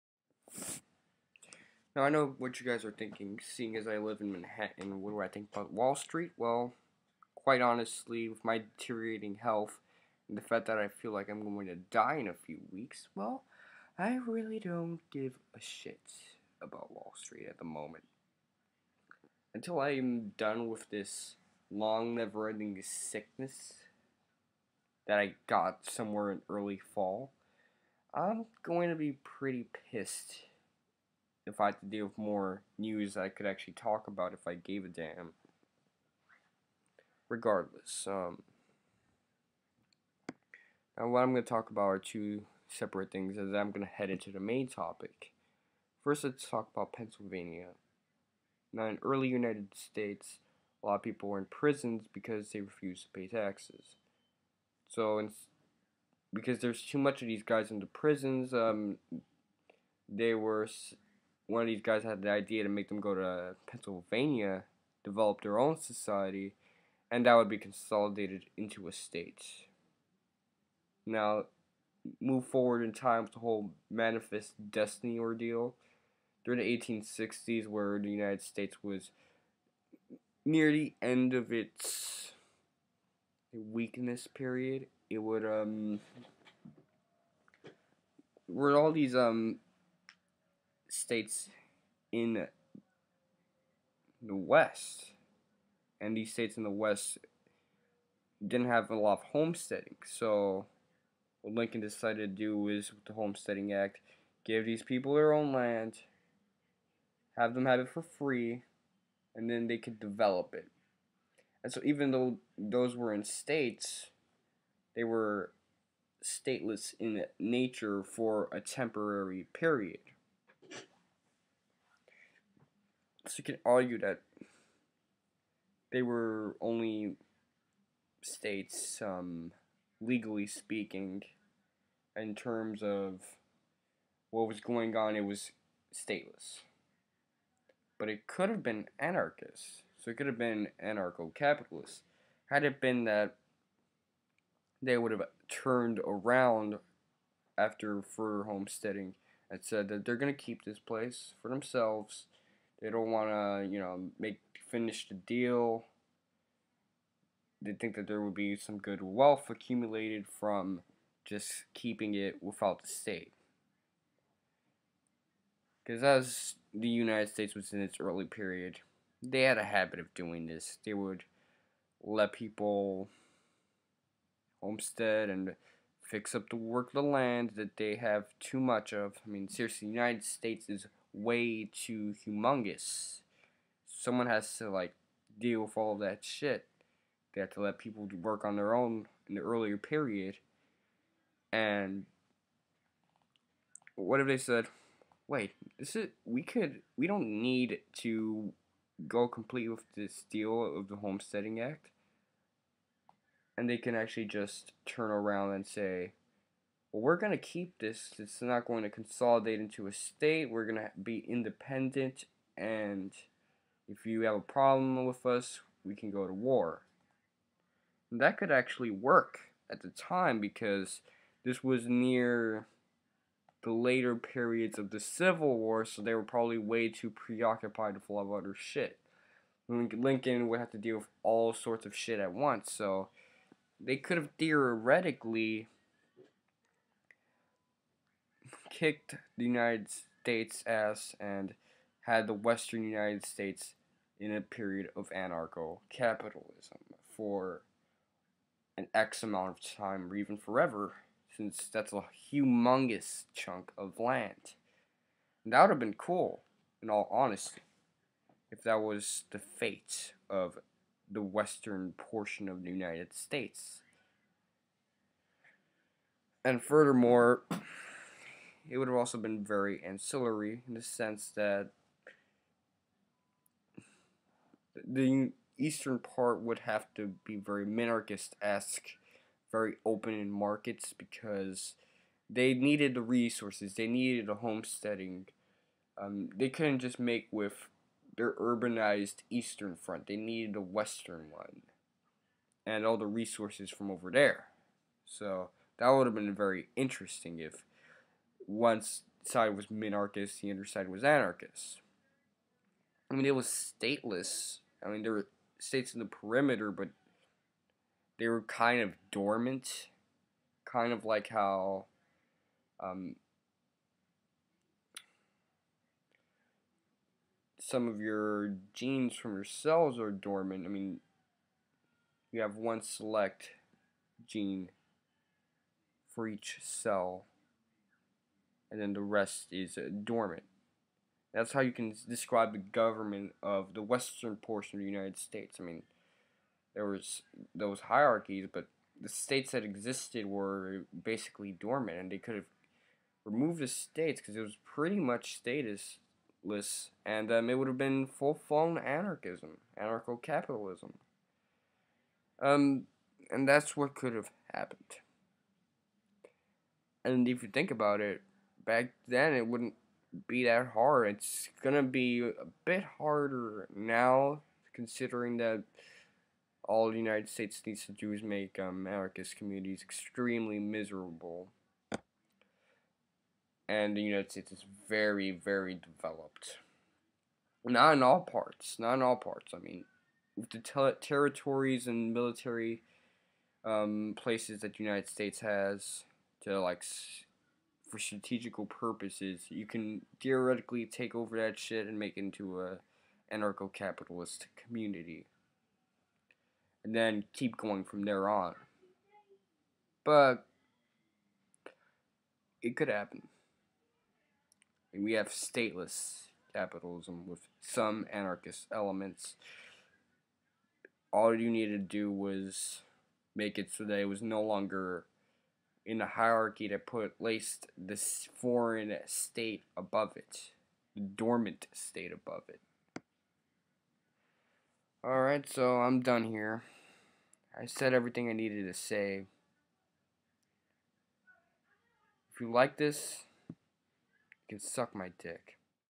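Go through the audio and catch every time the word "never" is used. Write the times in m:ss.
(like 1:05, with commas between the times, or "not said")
0:22.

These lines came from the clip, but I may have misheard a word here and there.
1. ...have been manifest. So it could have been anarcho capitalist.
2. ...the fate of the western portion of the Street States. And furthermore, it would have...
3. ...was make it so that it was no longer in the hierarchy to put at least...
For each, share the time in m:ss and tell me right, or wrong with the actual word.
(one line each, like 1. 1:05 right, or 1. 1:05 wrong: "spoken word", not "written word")
1. 2:18 wrong: "anarchist", not "manifest"
2. 4:19 wrong: "United", not "Street"
3. 6:52 right.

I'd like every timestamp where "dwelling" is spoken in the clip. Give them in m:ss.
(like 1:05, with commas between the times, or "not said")
not said.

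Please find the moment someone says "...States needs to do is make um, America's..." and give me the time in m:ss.
6:07.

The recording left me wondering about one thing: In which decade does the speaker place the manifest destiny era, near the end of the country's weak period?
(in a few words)
1860s.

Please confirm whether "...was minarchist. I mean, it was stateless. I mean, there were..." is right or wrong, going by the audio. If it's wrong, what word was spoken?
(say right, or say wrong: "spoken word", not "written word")
wrong: "anarchist", not "minarchist".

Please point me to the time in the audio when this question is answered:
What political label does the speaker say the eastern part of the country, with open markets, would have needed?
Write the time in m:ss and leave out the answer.
4:37.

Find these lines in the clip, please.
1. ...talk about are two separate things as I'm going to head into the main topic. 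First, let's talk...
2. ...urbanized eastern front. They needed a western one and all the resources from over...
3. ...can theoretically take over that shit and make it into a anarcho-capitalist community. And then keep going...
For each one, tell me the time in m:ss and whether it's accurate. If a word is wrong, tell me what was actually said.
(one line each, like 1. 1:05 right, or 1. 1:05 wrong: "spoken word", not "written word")
1. 0:41 right
2. 4:48 right
3. 6:29 right.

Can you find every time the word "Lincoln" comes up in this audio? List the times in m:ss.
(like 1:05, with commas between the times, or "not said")
1:41, 3:49.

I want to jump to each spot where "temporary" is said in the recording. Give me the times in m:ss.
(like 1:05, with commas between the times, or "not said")
1:58.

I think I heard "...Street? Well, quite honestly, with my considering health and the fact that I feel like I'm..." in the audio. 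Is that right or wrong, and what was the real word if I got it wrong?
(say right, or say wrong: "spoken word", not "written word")
wrong: "deteriorating", not "considering".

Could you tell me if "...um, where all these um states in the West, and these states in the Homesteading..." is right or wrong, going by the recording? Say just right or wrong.
wrong.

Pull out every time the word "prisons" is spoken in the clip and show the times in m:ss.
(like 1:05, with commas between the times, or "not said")
0:51, 0:57.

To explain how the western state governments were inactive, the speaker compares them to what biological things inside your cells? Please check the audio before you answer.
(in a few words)
genes.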